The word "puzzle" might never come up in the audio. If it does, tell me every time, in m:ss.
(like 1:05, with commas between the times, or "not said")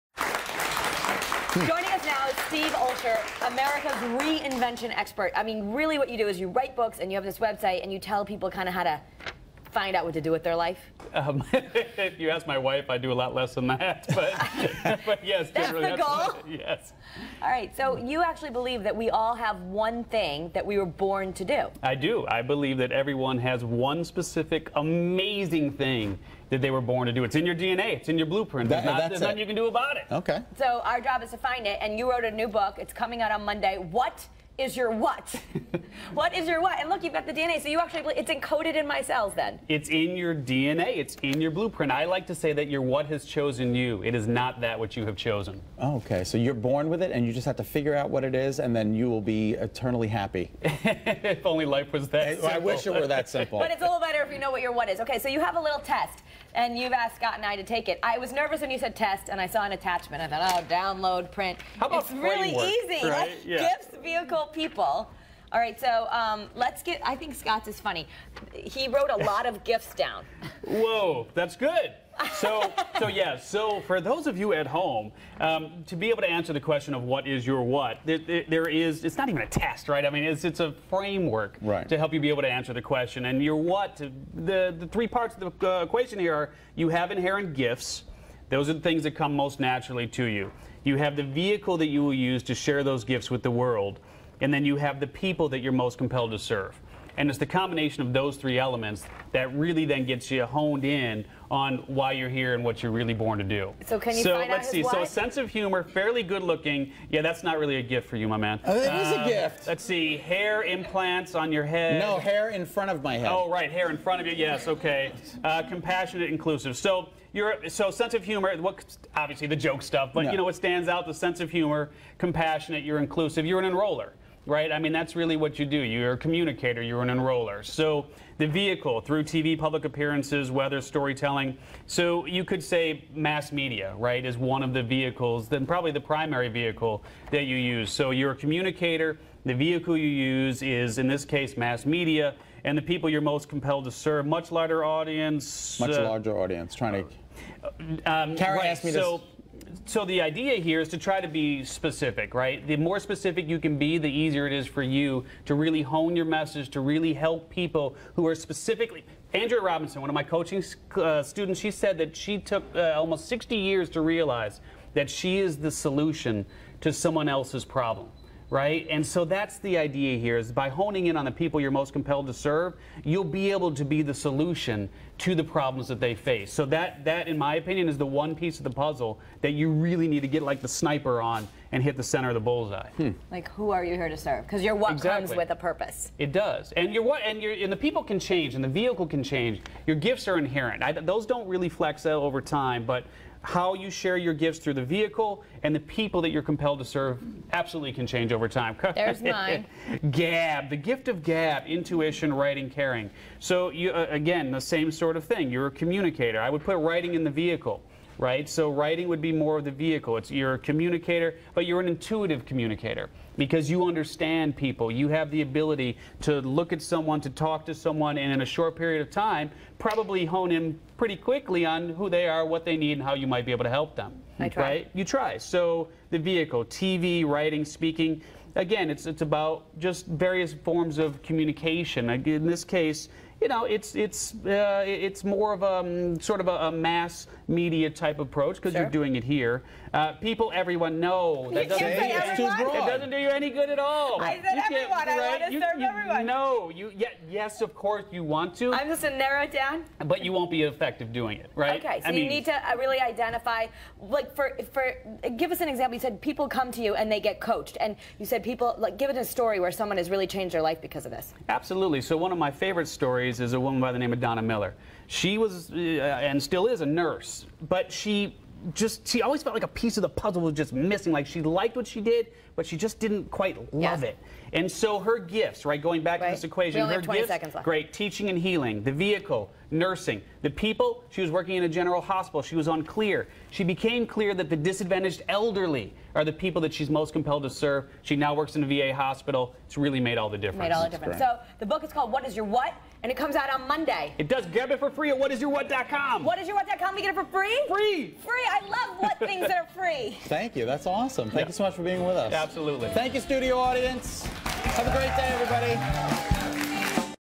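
2:58, 4:30.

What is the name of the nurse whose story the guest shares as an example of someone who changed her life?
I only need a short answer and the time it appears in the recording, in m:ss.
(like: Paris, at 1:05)
Donna Miller, at 4:24.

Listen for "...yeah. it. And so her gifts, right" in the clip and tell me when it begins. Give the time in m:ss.
4:34.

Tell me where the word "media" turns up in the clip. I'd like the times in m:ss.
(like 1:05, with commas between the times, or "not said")
2:13, 2:21, 3:57.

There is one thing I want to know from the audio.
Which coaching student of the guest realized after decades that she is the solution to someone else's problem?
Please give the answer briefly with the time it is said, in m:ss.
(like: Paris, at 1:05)
Andrea Robinson, at 2:39.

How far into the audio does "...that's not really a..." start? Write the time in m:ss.
1:47.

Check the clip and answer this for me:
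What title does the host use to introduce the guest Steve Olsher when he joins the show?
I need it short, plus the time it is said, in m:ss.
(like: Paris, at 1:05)
America's reinvention expert, at 0:03.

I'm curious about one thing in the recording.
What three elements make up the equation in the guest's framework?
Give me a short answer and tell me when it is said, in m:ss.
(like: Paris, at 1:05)
Gifts, vehicle, people, at 1:03.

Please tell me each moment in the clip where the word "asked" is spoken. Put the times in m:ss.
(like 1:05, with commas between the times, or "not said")
0:56, 2:28.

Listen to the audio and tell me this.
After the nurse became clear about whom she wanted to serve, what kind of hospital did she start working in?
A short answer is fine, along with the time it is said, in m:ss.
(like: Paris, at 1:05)
VA hospital, at 4:48.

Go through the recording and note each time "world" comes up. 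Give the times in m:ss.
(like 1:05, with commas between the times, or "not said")
1:33.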